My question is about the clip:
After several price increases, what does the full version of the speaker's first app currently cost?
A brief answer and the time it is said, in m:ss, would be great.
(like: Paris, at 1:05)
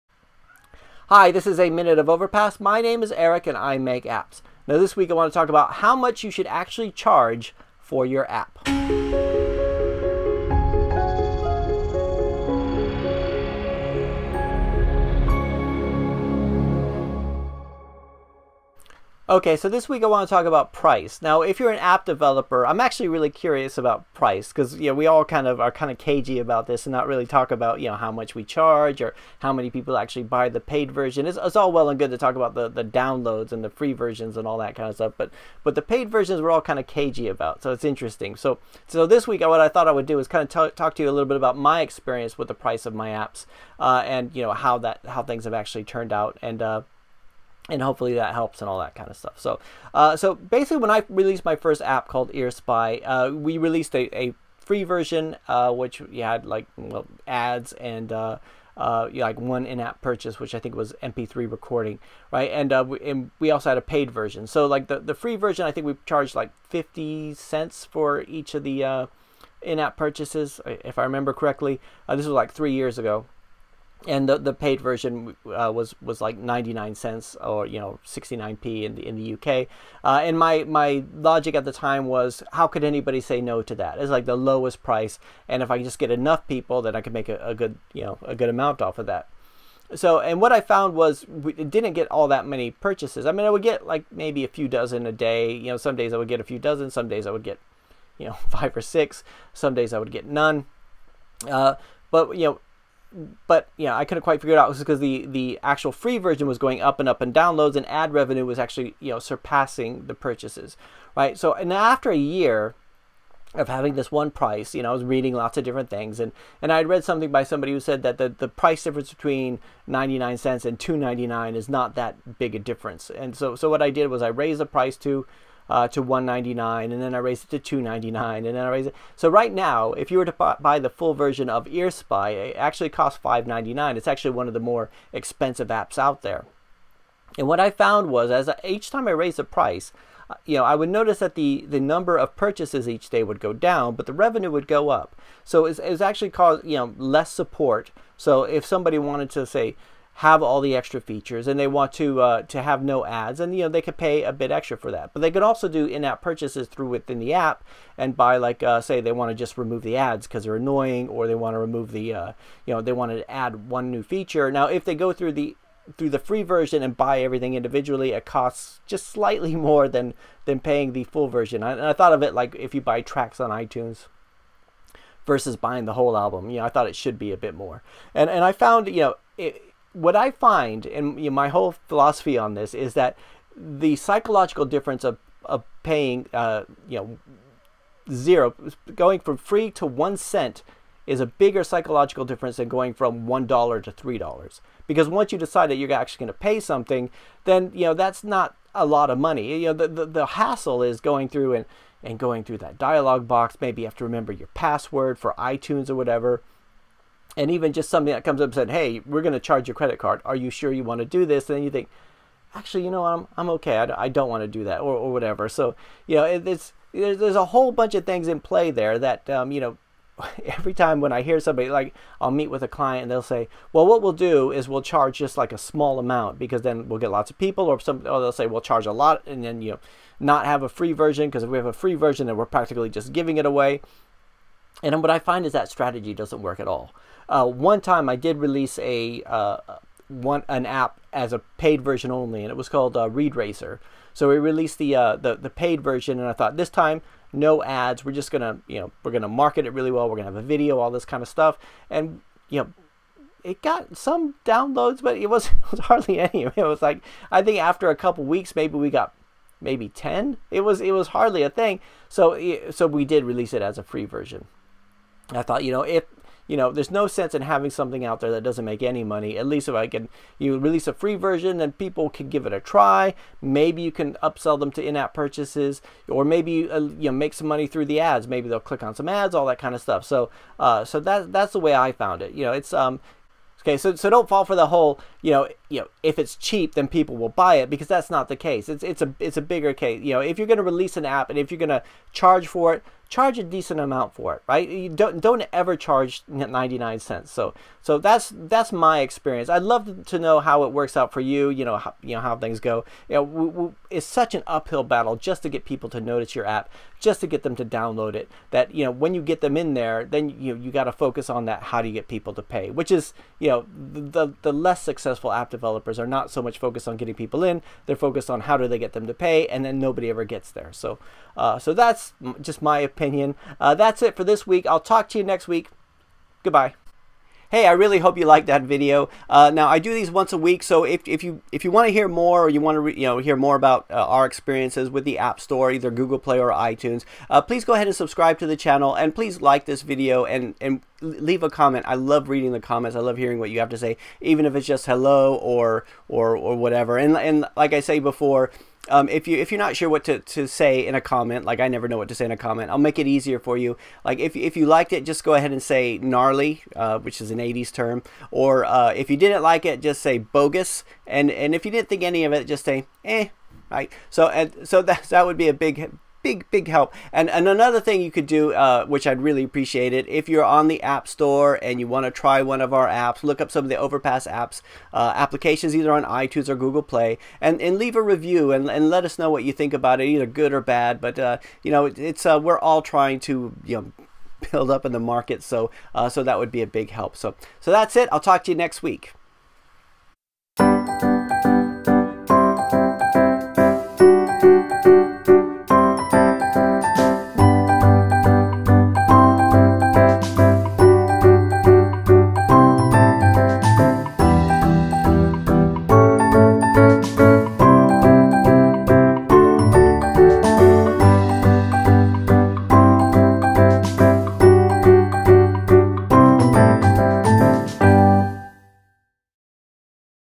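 5.99, at 2:13.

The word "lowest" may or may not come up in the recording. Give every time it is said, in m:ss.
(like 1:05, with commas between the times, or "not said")
1:24.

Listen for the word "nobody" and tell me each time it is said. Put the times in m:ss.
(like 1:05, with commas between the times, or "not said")
5:19.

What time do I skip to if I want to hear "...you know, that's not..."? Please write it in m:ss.
3:17.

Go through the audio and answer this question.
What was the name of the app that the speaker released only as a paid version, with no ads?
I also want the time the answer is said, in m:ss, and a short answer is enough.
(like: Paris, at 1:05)
Read Racer, at 4:03.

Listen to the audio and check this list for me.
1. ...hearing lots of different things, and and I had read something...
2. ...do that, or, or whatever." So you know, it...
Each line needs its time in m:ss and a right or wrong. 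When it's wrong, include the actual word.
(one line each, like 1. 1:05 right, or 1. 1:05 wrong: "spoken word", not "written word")
1. 1:55 wrong: "reading", not "hearing"
2. 3:34 right.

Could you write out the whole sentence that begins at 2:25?
So it's, was actually caused, you know, less support.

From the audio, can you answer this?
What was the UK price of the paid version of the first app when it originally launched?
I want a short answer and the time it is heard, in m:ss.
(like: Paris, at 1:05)
69p, at 1:18.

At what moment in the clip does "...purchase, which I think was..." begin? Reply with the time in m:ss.
1:00.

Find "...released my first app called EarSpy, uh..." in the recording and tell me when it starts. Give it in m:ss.
0:51.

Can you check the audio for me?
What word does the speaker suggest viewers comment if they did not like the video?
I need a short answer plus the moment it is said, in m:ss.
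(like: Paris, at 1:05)
bogus, at 6:00.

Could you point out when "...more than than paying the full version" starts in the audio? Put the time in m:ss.
2:49.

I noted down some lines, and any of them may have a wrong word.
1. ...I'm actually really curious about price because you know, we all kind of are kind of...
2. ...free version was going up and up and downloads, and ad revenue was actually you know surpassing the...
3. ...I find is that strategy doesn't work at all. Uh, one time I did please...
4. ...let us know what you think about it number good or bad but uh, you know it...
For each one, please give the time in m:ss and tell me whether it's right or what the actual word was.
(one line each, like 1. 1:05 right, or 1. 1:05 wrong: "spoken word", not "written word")
1. 0:22 right
2. 1:45 right
3. 3:55 wrong: "release", not "please"
4. 6:18 wrong: "either", not "number".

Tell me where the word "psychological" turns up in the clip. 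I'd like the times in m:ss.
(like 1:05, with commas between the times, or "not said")
3:03, 3:11.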